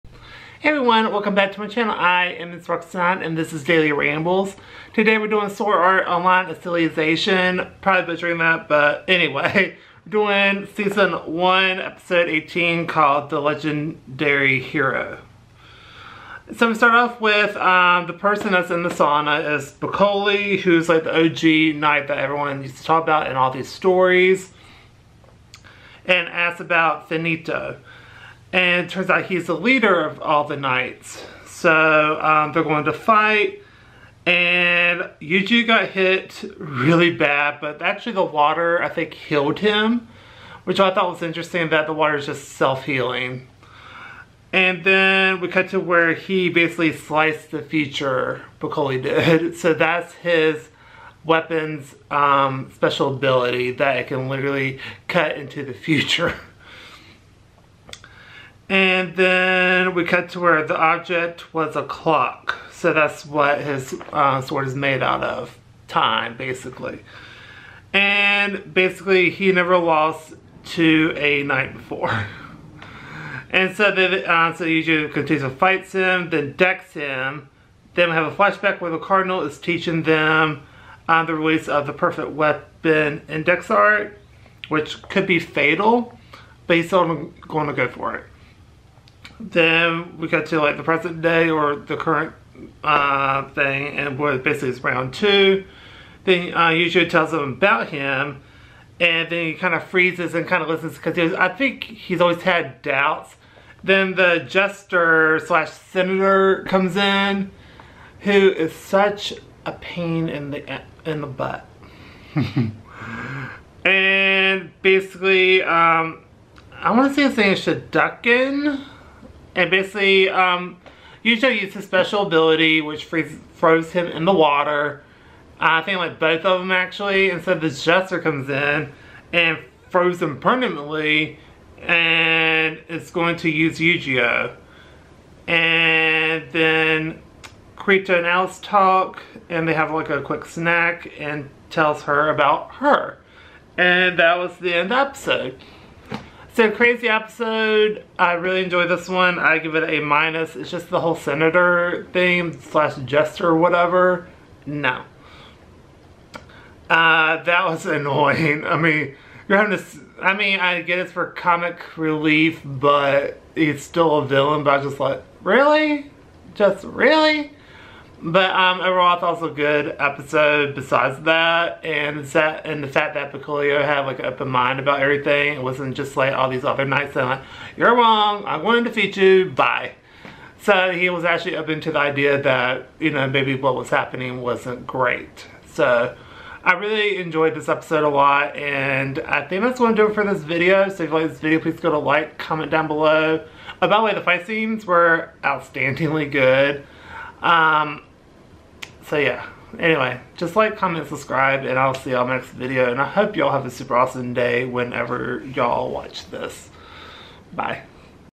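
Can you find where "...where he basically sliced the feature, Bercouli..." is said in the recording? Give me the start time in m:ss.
0:45.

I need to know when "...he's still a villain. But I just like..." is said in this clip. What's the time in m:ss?
2:43.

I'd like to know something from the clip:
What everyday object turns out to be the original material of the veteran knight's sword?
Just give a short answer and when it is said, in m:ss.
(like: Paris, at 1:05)
A clock, at 1:01.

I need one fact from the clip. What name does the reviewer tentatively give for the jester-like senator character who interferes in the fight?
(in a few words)
Shadukin.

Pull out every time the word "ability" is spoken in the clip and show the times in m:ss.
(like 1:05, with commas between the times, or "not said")
0:53, 2:02.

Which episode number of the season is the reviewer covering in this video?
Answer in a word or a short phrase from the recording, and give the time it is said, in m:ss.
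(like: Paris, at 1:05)
18, at 0:11.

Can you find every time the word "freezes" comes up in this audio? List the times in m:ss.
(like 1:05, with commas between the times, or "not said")
1:39, 2:03.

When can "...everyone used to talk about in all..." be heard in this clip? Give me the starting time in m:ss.
0:22.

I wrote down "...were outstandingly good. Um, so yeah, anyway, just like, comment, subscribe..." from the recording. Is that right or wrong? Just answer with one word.
right.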